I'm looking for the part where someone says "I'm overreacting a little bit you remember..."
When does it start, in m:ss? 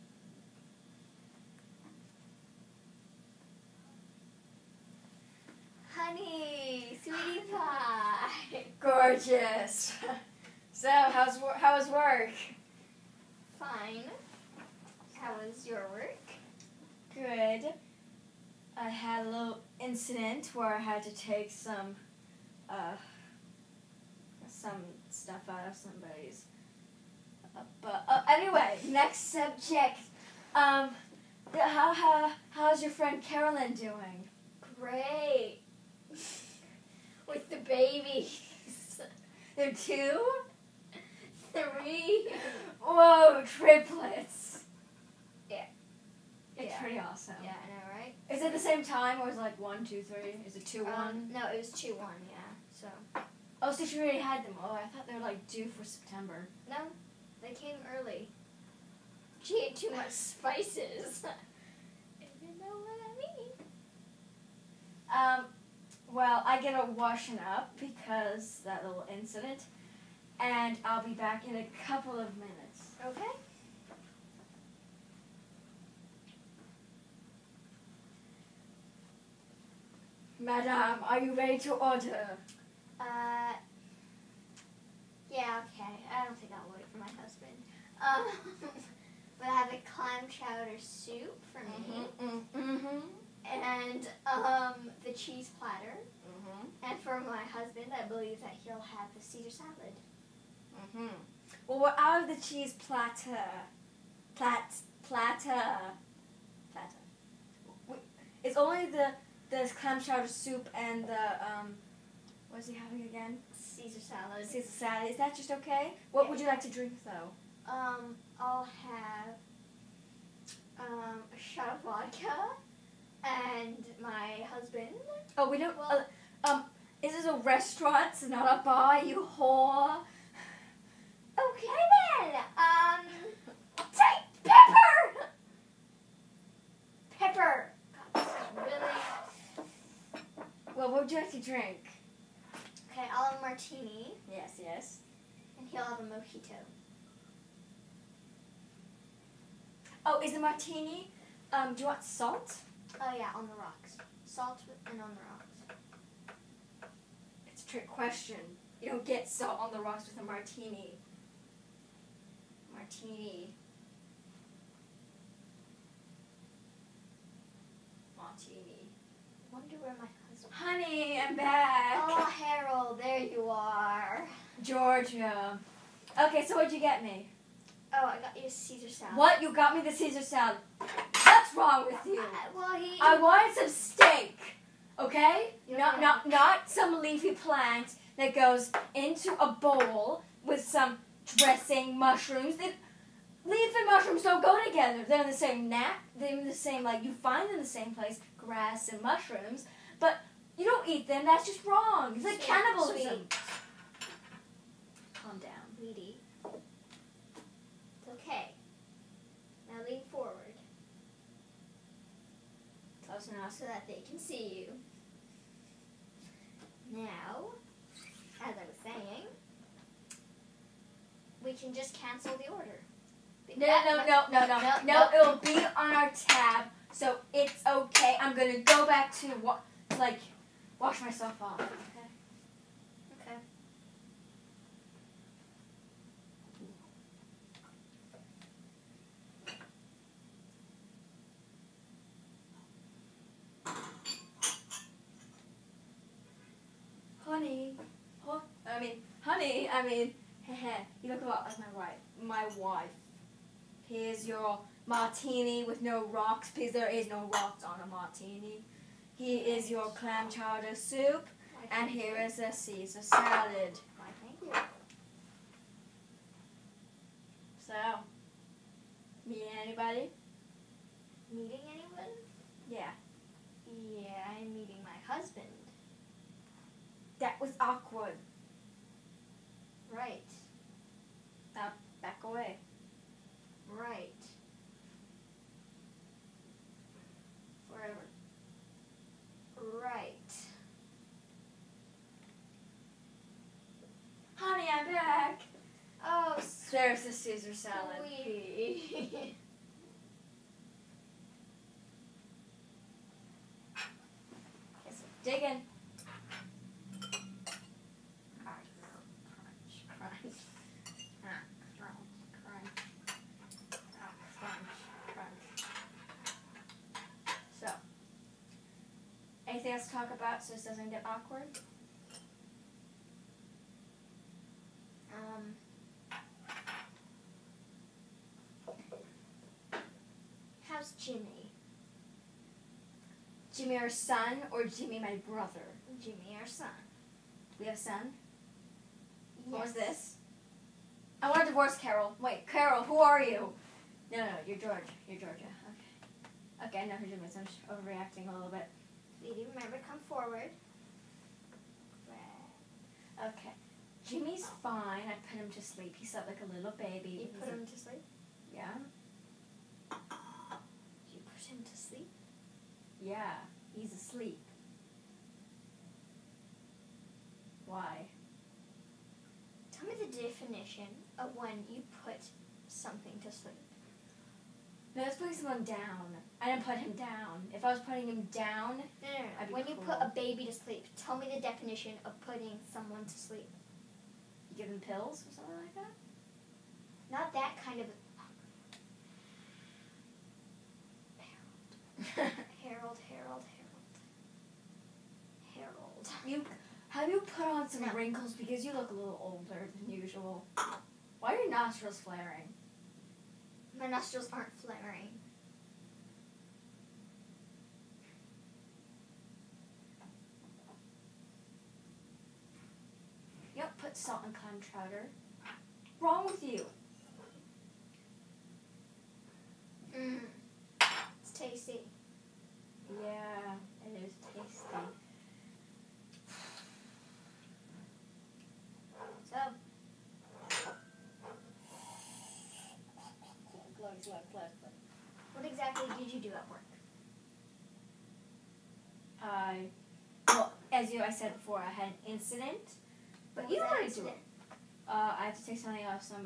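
5:47.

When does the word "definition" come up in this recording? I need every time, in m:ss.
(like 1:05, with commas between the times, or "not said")
6:10, 6:21.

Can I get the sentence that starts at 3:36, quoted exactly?
Now, as I was saying, we can just cancel the order.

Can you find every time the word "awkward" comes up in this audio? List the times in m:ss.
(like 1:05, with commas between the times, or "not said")
4:37, 5:21.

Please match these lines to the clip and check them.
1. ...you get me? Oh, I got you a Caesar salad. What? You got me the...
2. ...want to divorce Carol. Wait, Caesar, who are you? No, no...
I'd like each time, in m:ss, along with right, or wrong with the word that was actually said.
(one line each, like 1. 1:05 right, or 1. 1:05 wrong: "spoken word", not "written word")
1. 2:56 right
2. 5:41 wrong: "Carol", not "Caesar".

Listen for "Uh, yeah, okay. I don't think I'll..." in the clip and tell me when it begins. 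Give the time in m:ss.
1:22.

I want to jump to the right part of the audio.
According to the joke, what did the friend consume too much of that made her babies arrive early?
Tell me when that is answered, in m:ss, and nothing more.
1:00.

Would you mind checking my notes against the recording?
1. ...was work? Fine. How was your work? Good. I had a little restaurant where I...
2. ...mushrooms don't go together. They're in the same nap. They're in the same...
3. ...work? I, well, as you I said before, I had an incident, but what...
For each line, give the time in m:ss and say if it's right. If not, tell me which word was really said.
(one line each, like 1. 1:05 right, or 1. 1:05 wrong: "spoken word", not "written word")
1. 0:11 wrong: "incident", not "restaurant"
2. 3:13 right
3. 7:16 right.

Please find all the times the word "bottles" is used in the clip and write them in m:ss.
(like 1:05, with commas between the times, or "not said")
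not said.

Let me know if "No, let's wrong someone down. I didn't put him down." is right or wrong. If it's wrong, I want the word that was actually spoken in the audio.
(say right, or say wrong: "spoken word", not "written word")
wrong: "putting", not "wrong".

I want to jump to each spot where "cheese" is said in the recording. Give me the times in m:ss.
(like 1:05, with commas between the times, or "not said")
1:35, 1:42.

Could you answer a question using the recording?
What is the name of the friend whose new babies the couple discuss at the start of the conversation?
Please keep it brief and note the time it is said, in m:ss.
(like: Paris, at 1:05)
Carolyn, at 0:33.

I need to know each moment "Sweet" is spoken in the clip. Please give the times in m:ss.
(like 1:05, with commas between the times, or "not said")
4:58.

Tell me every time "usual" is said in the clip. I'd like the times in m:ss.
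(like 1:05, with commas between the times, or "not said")
6:39.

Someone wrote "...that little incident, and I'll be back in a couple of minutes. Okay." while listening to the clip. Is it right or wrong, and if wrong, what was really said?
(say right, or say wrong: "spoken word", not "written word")
right.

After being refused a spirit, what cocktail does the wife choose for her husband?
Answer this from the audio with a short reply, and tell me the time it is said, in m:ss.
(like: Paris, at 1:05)
Mojito, at 2:26.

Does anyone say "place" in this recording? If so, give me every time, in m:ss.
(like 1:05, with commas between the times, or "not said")
3:17.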